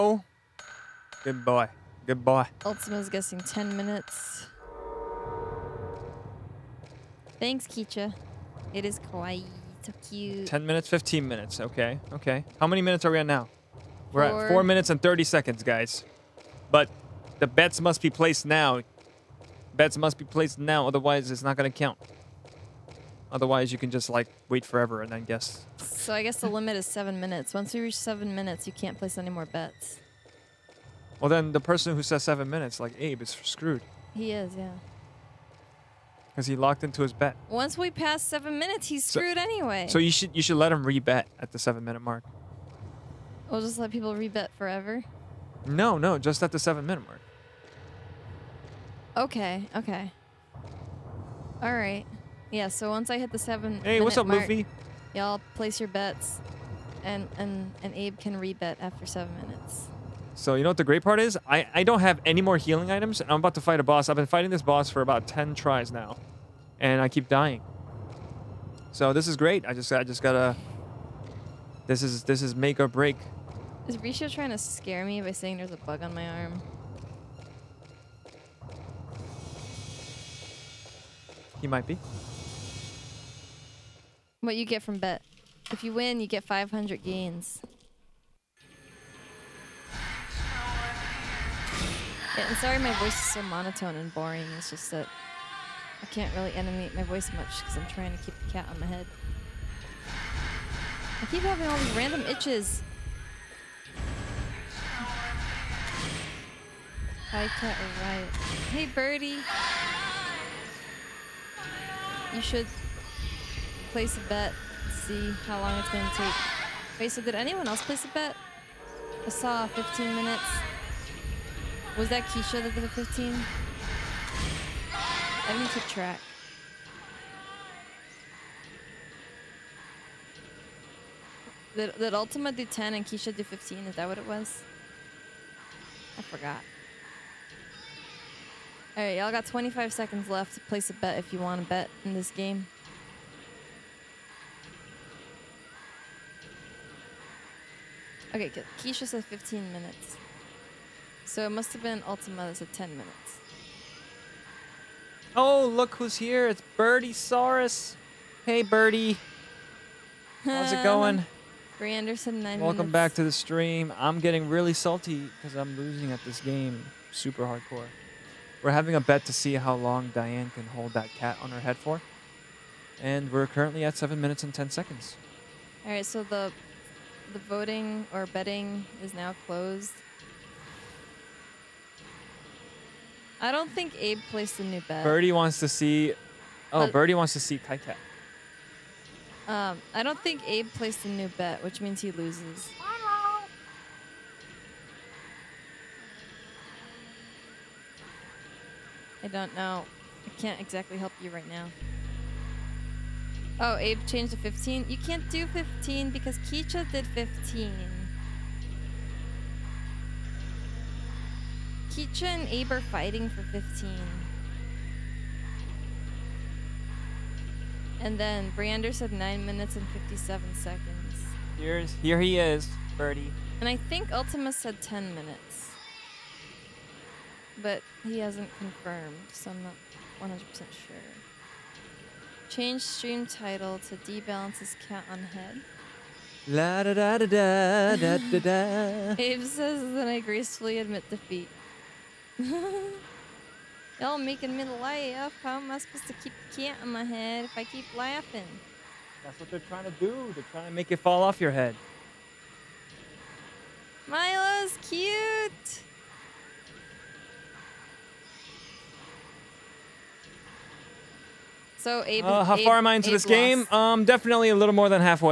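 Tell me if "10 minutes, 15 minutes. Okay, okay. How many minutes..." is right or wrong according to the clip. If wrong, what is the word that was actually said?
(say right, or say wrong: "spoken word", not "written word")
right.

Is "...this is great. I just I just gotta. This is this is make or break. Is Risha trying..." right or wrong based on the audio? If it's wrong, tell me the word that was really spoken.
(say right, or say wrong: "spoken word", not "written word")
right.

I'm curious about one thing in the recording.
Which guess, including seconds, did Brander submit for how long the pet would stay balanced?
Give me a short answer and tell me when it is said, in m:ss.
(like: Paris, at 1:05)
9 minutes and 57 seconds, at 3:39.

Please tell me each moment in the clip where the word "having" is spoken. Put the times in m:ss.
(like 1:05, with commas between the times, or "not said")
1:41, 2:48.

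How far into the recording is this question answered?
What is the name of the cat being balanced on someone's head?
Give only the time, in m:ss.
4:14.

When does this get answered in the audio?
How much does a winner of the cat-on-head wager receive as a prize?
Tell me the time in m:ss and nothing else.
1:26.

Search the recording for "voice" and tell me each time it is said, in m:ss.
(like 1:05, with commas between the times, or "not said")
1:32, 1:37.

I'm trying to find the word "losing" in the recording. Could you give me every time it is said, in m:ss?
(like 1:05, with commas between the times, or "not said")
2:45.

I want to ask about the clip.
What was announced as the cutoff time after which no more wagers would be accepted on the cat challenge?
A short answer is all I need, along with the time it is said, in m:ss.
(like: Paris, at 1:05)
7 minutes, at 0:26.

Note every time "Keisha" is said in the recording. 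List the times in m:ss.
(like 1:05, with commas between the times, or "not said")
0:07, 2:02, 2:13, 2:28, 3:26, 3:31.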